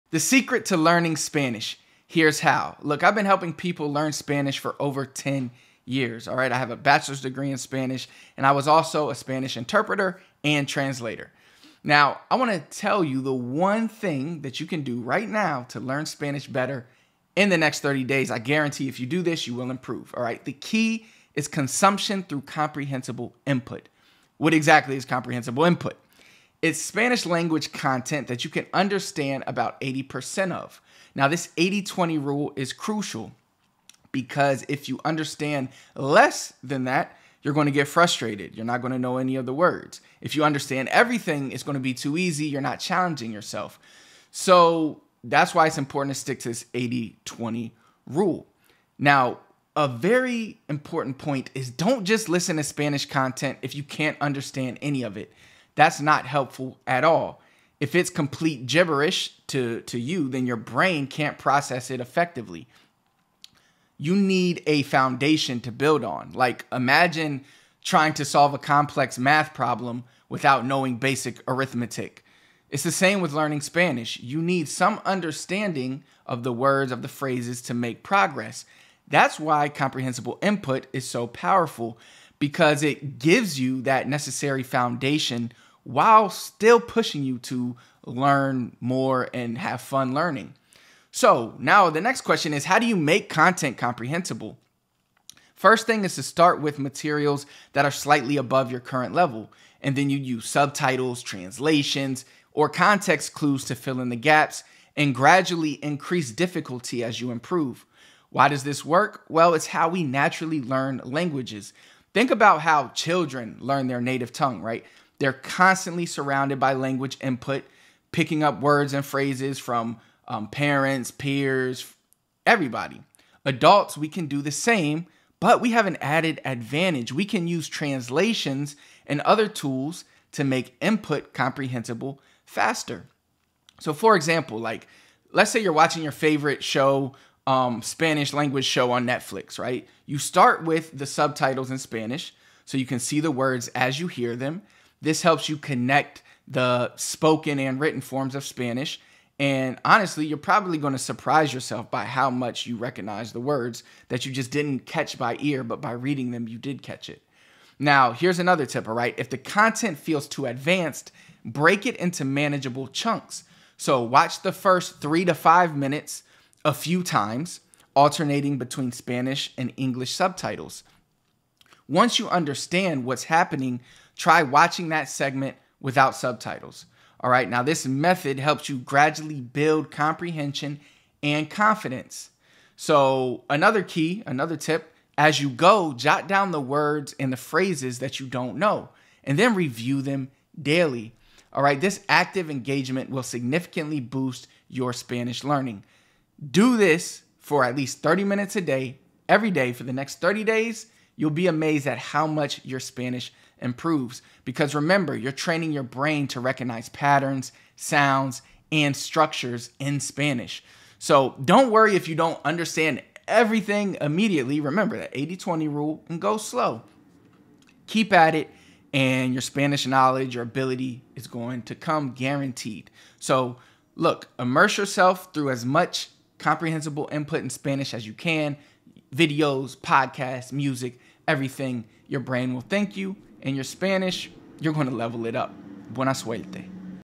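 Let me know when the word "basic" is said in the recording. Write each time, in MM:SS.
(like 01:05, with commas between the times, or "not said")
01:10.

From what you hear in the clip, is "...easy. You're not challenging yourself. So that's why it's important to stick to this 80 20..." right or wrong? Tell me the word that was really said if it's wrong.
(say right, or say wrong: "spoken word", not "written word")
right.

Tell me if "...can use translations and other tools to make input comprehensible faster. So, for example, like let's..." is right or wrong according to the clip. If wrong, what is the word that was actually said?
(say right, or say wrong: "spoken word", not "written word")
right.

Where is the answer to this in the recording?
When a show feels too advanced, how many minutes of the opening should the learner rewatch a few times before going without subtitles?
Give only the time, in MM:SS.
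02:45.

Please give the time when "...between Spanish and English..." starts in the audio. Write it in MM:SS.
02:48.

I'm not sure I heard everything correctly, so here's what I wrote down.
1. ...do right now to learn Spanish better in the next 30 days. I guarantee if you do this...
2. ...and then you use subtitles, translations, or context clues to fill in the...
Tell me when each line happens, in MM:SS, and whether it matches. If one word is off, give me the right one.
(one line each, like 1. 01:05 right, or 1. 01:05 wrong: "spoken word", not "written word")
1. 00:14 right
2. 01:39 right.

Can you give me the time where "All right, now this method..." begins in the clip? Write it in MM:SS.
02:57.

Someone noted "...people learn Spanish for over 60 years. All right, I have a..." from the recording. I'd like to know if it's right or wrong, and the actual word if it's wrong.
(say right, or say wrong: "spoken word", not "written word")
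wrong: "10", not "60".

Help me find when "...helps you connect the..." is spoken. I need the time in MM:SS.
02:25.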